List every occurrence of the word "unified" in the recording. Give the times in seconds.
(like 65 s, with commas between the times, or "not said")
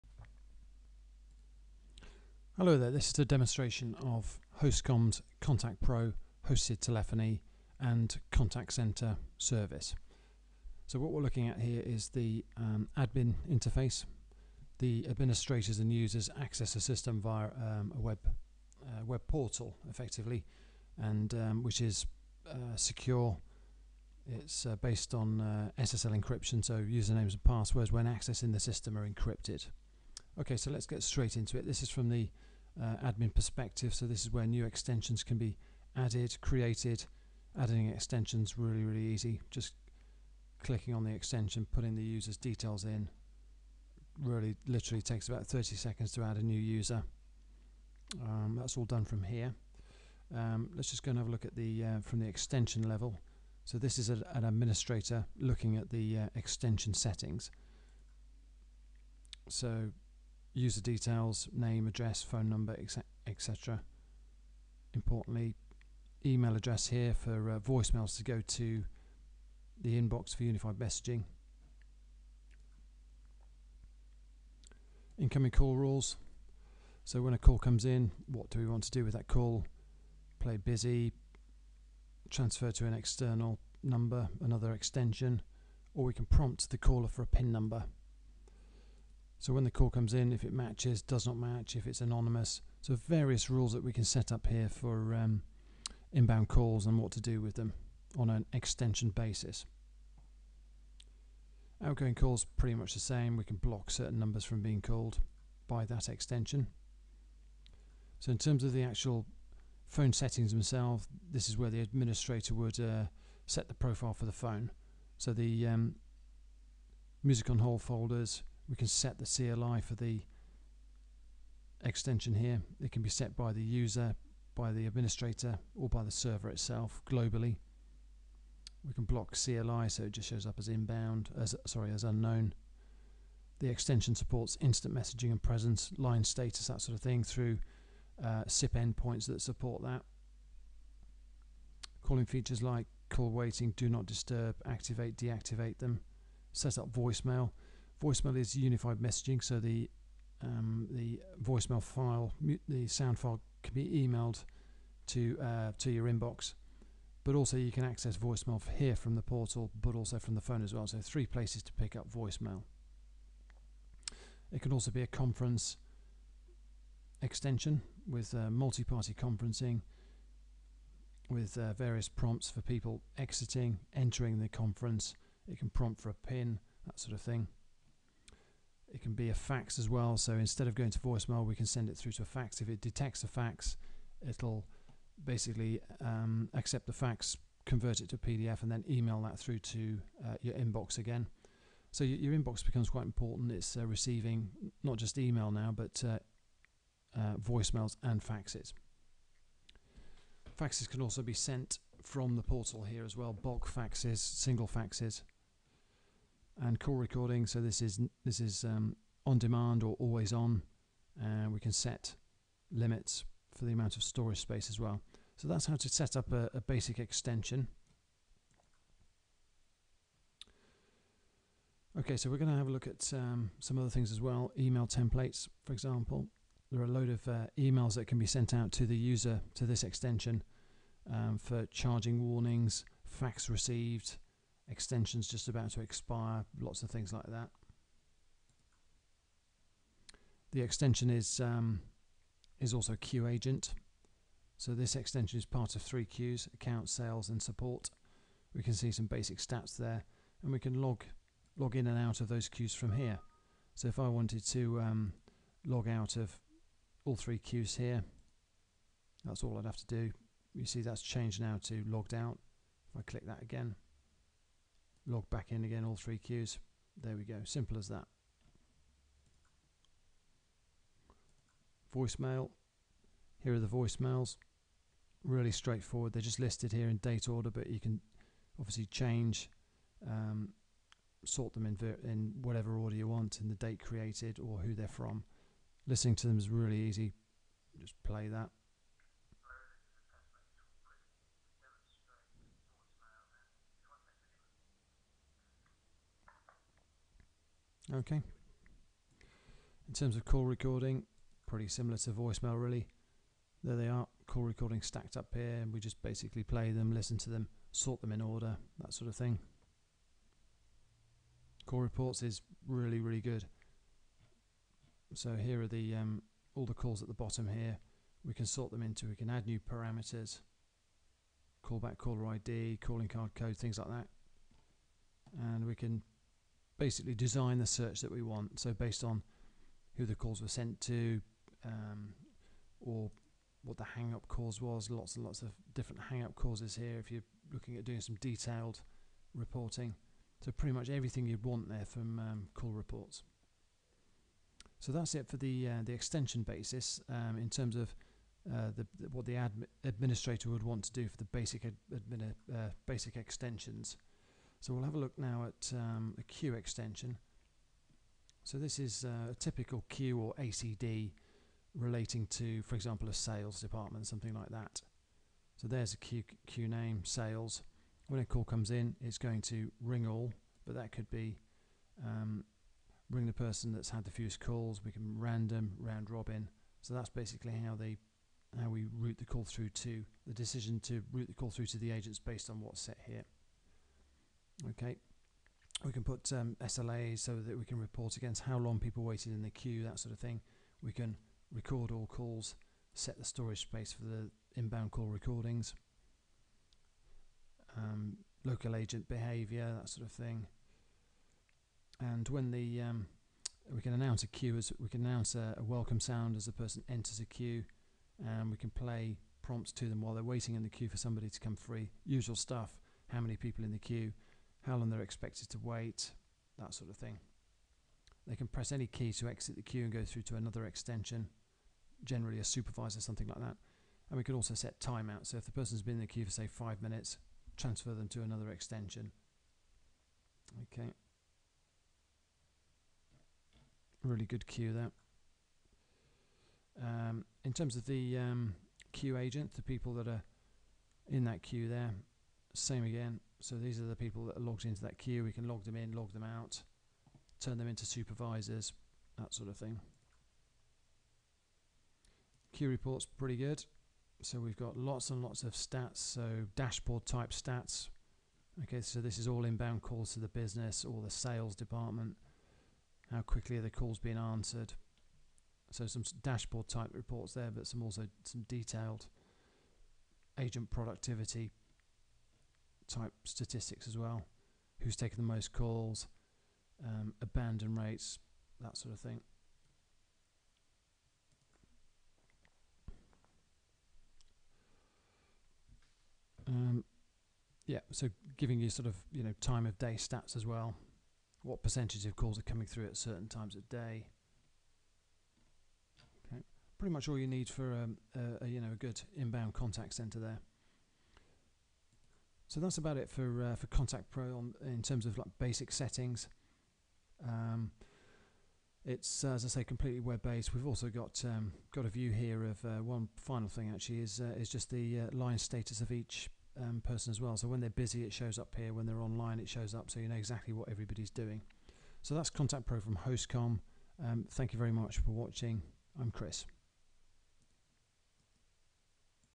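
70 s, 148 s.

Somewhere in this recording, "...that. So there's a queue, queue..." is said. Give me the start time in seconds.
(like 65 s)
364 s.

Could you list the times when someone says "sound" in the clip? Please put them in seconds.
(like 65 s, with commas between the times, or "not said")
152 s, 405 s.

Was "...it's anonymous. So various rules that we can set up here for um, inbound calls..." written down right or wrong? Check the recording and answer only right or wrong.
right.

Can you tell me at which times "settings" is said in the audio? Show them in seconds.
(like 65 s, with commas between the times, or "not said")
56 s, 110 s, 505 s.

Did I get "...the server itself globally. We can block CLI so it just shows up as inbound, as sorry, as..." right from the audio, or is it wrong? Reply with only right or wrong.
right.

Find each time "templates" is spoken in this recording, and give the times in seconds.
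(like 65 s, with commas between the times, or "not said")
224 s.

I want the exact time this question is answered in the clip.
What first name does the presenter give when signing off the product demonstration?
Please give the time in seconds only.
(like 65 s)
526 s.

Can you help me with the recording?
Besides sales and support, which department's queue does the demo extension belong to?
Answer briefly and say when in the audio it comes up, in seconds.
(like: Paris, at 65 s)
account, at 246 s.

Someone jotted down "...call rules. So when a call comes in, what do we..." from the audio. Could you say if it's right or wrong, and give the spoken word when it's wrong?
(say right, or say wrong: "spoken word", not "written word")
right.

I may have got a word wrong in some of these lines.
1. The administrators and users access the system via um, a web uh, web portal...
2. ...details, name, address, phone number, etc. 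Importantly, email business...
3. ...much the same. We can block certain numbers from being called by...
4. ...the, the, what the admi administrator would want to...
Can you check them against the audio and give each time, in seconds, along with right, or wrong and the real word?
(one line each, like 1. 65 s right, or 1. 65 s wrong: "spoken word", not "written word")
1. 14 s right
2. 60 s wrong: "address", not "business"
3. 102 s right
4. 348 s right.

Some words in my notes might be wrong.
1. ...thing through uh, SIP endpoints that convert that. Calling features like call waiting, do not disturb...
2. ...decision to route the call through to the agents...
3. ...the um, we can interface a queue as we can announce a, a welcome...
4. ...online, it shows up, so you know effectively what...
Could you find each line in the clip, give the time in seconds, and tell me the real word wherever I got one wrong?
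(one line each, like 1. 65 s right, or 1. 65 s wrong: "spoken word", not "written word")
1. 137 s wrong: "support", not "convert"
2. 380 s right
3. 402 s wrong: "announce", not "interface"
4. 518 s wrong: "exactly", not "effectively".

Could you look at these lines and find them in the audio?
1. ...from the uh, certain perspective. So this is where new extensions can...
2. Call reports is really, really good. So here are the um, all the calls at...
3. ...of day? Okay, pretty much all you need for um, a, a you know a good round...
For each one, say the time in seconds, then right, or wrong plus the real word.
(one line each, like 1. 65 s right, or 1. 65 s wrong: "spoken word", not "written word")
1. 31 s wrong: "admin", not "certain"
2. 311 s right
3. 493 s wrong: "inbound", not "round".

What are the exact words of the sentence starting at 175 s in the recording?
It can prompt for a pin, that sort of thing.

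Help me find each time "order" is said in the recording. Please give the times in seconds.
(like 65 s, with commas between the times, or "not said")
277 s, 282 s, 308 s.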